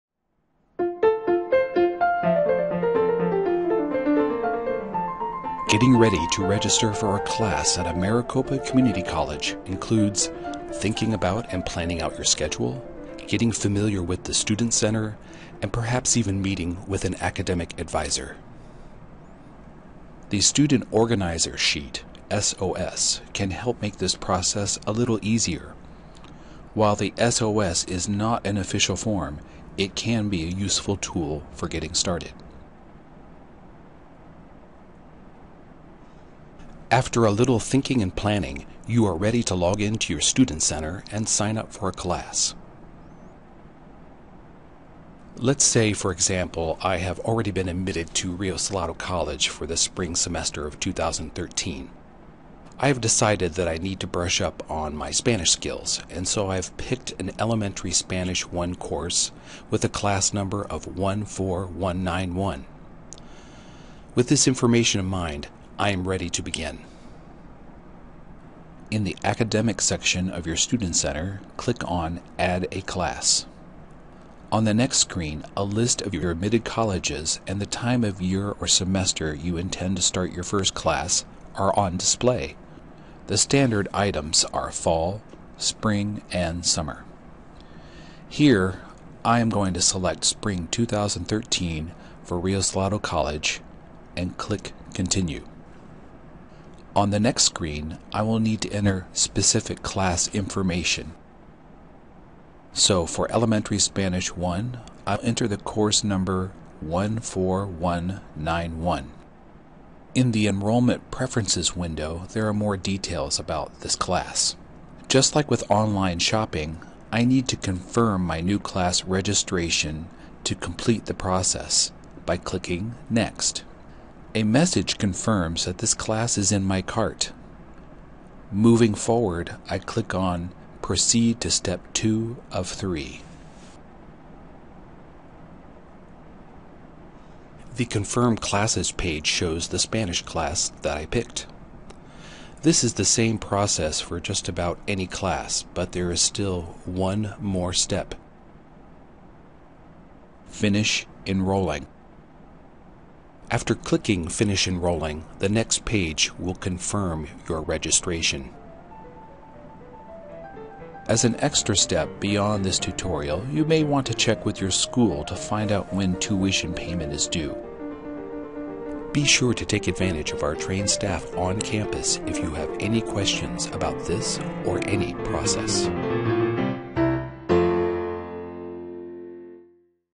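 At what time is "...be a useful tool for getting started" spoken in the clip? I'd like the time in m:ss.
0:30.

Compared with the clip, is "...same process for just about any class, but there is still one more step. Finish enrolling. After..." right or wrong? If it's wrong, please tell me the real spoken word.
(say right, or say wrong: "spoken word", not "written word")
right.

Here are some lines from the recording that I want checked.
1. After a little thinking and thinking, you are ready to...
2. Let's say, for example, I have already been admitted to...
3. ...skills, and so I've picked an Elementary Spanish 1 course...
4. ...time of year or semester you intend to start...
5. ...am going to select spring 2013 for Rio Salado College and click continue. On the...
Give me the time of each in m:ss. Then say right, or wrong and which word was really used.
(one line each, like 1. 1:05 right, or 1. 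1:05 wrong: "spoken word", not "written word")
1. 0:36 wrong: "planning", not "thinking"
2. 0:45 right
3. 0:55 right
4. 1:17 right
5. 1:29 right.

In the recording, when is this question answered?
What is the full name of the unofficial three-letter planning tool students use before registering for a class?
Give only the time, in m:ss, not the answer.
0:20.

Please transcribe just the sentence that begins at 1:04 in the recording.
With this information in mind, I am ready to begin.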